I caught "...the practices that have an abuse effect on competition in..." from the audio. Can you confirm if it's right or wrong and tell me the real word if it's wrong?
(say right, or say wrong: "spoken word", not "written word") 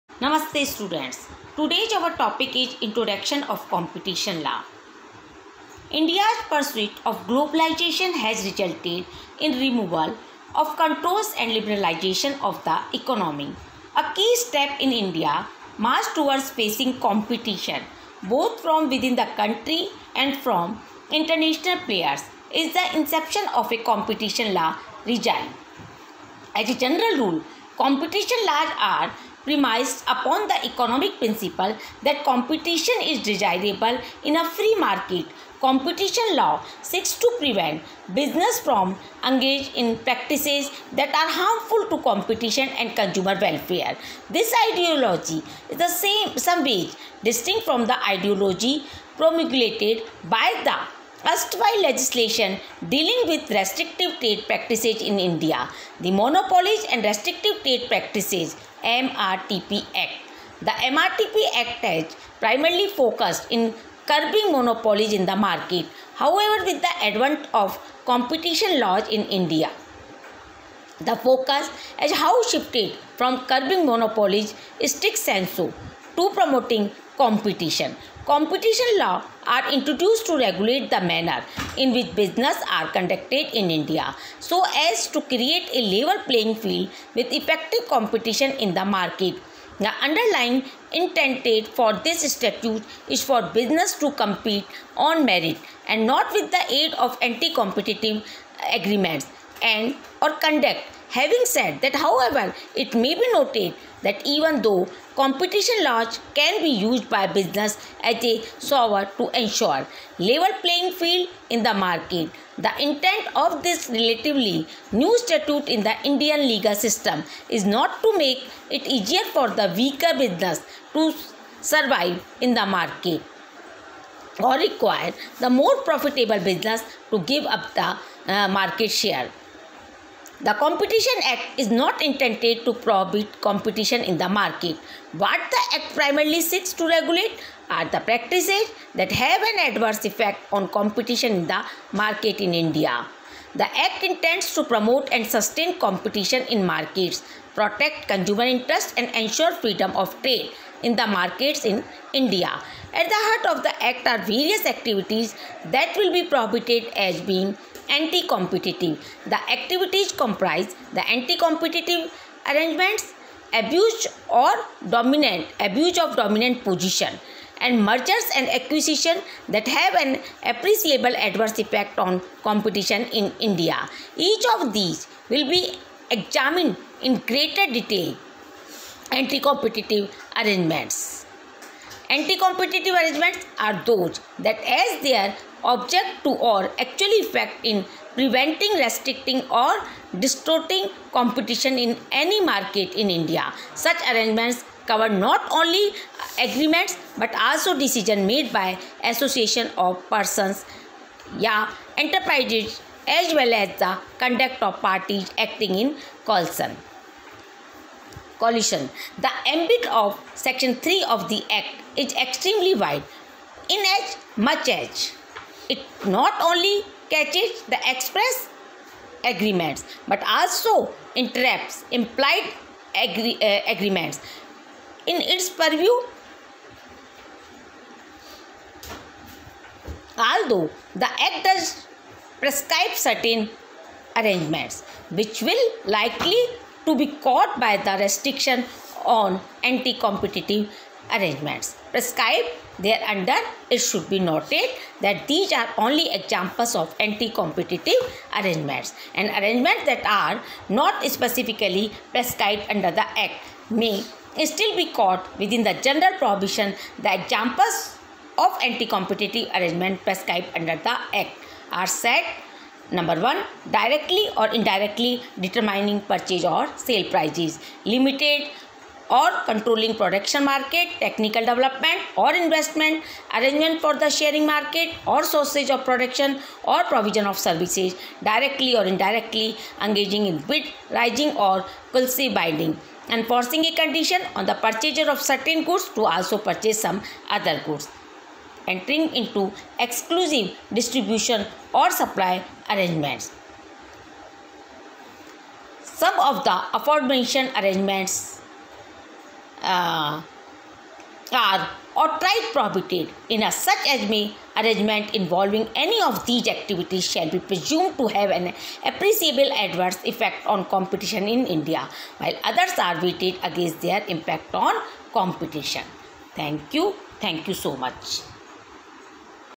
wrong: "adverse", not "abuse".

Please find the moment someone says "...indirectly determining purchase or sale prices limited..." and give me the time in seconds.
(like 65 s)
264 s.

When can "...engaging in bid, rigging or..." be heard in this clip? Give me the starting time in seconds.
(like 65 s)
279 s.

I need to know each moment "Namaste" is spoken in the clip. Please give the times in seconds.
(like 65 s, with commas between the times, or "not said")
0 s.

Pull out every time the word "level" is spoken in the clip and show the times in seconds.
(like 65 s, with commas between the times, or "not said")
85 s, 110 s.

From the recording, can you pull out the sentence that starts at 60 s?
The MRTP Act has primarily focused in curbing monopolies in the market, however, with the advent of competition laws in India.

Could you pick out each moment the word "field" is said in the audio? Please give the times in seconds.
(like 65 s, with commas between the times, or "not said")
86 s, 110 s.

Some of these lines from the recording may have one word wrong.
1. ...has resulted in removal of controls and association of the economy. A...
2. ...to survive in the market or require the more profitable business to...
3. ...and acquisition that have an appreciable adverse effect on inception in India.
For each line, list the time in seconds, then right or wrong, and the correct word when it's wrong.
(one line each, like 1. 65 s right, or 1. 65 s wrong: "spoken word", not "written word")
1. 8 s wrong: "liberalization", not "association"
2. 120 s right
3. 168 s wrong: "competition", not "inception".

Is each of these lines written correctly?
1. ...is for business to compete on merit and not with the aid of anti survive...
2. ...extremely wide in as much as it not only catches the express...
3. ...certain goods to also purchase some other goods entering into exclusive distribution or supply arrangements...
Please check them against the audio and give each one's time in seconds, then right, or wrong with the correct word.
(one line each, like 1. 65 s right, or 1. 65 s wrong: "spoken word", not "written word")
1. 93 s wrong: "competitive", not "survive"
2. 212 s right
3. 285 s right.